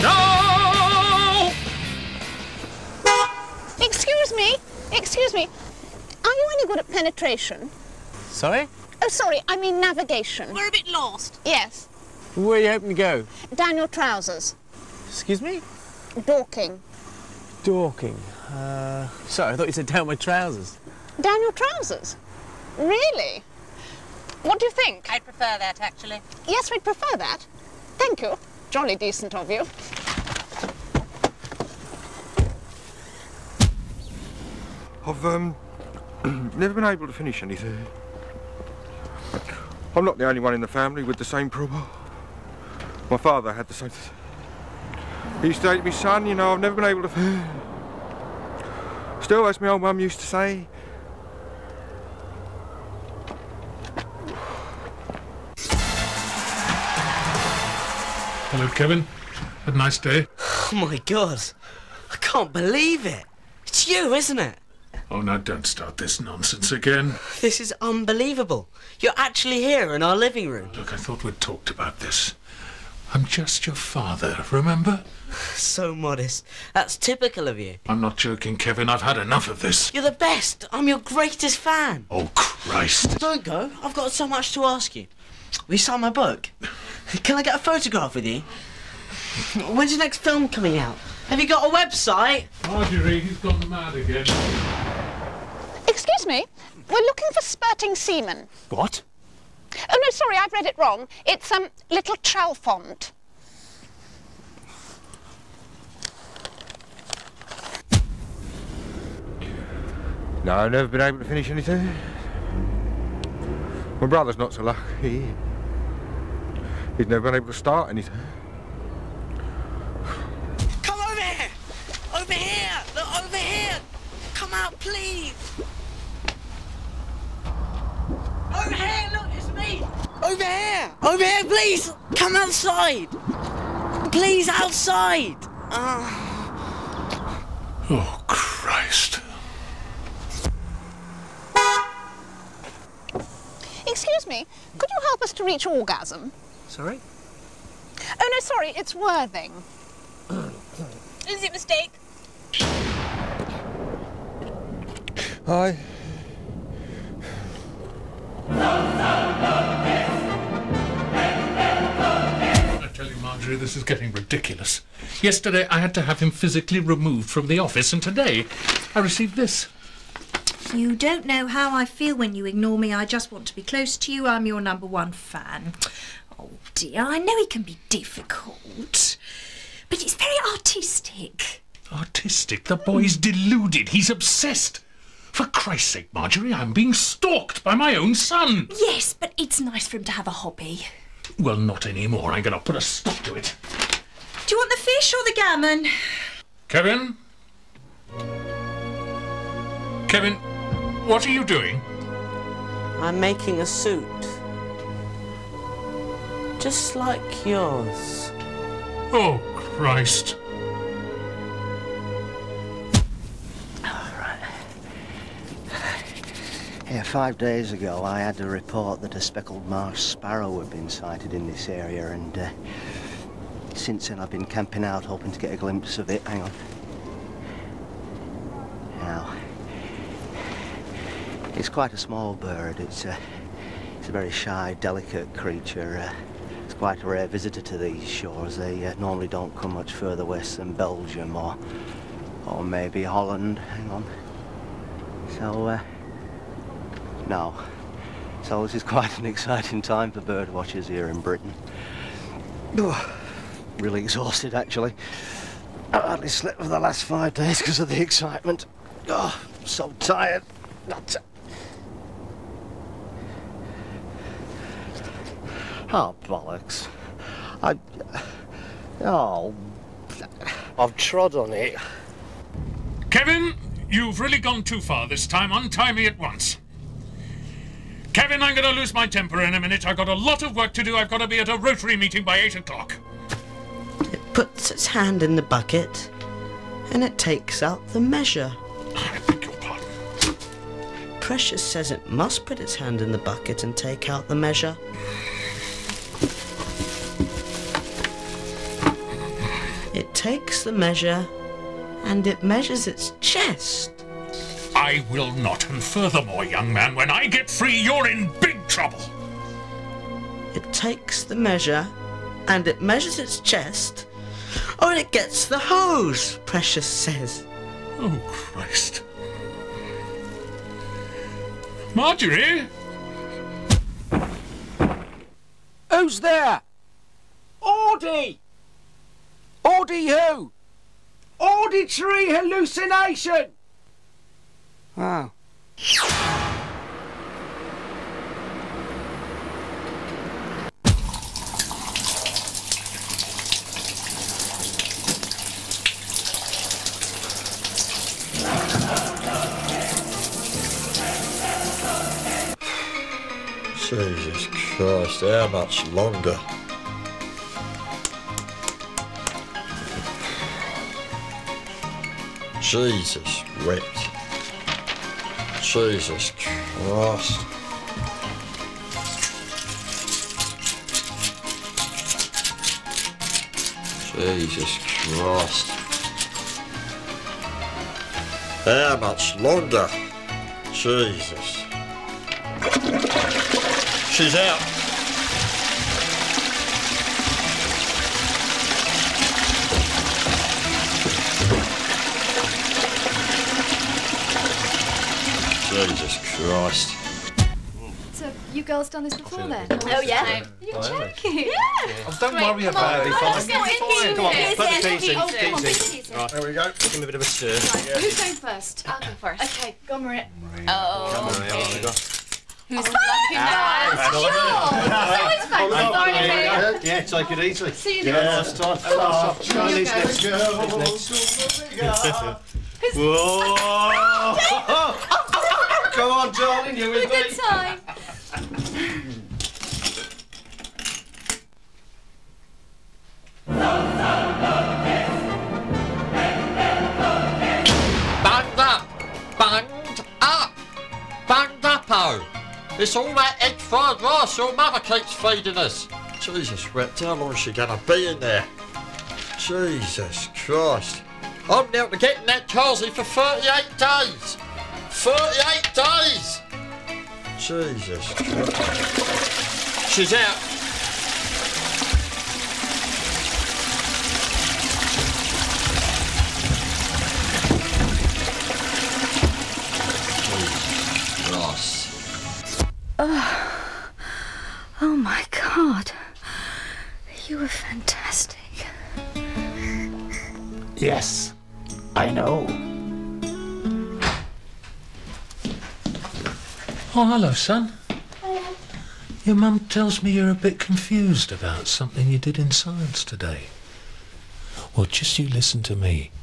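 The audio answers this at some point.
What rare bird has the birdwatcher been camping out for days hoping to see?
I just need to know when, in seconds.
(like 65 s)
219 s.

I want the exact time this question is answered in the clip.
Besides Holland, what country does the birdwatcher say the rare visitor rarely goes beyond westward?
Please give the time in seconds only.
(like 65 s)
240 s.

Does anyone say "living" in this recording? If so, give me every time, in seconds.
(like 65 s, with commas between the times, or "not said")
70 s.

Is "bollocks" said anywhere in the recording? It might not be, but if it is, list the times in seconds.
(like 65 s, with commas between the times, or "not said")
266 s.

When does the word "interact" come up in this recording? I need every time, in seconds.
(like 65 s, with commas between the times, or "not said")
not said.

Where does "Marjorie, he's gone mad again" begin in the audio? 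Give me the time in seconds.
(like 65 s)
92 s.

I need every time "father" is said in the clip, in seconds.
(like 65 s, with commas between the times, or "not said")
43 s, 73 s.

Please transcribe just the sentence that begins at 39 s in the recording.
I'm not the only one in the family with the same problem.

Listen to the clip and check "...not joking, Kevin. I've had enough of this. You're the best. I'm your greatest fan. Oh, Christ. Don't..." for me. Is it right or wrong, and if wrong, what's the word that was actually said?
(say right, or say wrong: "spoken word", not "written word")
right.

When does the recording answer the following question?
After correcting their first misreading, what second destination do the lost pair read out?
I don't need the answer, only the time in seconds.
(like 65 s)
101 s.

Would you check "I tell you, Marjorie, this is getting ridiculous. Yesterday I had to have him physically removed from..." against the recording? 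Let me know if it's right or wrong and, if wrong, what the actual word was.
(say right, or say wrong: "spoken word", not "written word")
right.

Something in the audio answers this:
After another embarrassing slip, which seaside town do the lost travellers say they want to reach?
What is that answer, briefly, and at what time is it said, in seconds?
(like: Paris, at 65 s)
Worthing, at 148 s.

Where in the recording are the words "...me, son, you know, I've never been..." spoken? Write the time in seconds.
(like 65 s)
45 s.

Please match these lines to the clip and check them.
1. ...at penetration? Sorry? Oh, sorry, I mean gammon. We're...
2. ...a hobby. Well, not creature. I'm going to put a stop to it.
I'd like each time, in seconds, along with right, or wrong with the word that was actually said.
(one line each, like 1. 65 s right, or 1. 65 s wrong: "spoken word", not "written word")
1. 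6 s wrong: "navigation", not "gammon"
2. 190 s wrong: "anymore", not "creature".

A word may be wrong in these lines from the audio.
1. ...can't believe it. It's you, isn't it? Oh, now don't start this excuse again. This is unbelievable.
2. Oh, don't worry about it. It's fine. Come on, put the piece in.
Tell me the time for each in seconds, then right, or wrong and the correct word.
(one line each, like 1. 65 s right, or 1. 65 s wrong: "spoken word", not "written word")
1. 62 s wrong: "nonsense", not "excuse"
2. 402 s right.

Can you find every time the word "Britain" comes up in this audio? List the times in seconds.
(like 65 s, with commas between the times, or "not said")
251 s.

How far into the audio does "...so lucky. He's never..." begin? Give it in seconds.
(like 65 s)
114 s.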